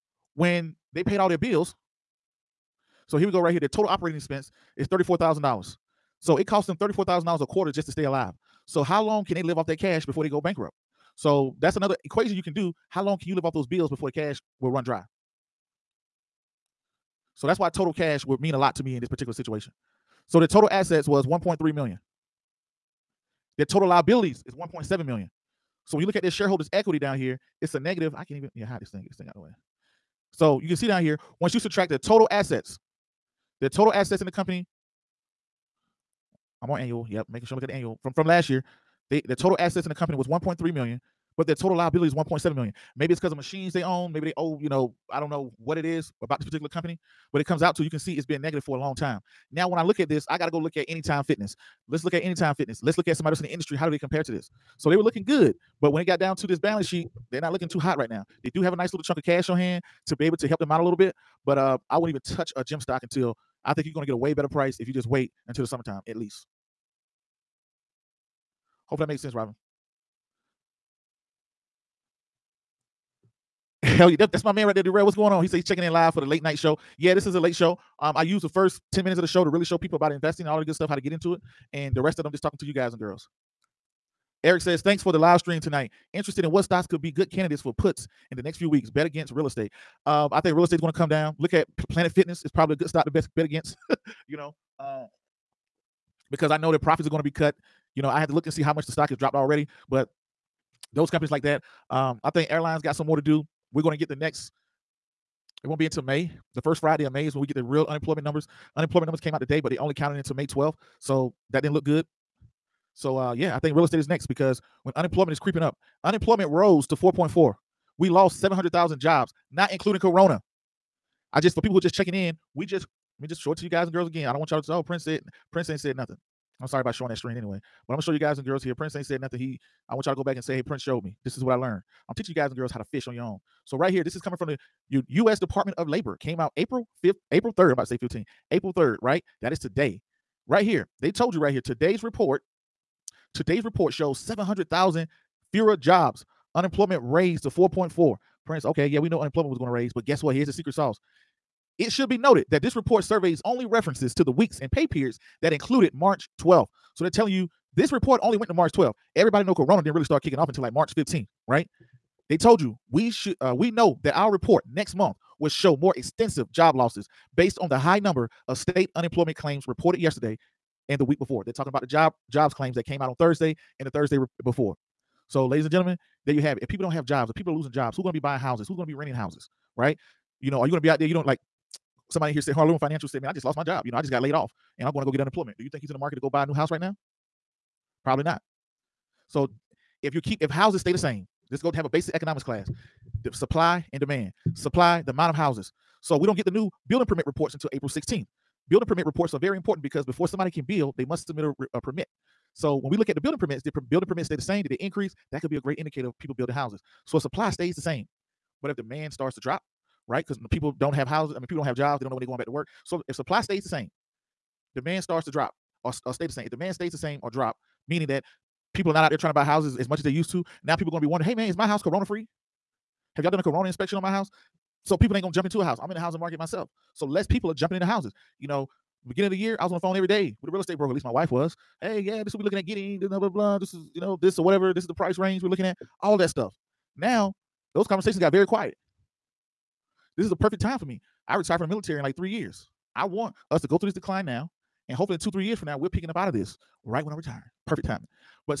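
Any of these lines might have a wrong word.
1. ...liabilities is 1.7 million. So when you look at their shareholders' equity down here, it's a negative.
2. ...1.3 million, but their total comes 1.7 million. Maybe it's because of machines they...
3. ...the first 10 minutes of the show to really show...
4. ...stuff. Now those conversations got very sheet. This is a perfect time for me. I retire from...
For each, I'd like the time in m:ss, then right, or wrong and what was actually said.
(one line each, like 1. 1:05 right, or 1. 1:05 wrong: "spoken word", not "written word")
1. 0:23 right
2. 0:40 wrong: "liabilities", not "comes"
3. 1:18 right
4. 3:56 wrong: "quiet", not "sheet".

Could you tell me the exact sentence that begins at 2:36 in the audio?
So they're telling you this report only went to March 12th.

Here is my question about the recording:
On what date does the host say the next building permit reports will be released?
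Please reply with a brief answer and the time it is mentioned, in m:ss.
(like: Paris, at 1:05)
April 16th, at 3:17.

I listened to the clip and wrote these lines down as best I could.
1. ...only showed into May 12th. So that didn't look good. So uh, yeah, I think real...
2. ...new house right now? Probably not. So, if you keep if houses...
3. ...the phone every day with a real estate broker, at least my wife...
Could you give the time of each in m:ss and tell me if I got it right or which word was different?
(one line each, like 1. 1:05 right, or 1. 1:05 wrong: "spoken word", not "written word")
1. 1:49 wrong: "counted", not "showed"
2. 3:06 right
3. 3:49 right.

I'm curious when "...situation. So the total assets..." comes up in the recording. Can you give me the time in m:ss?
0:19.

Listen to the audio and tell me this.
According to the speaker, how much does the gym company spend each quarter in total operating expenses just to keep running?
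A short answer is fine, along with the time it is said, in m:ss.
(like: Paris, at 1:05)
$34,000, at 0:06.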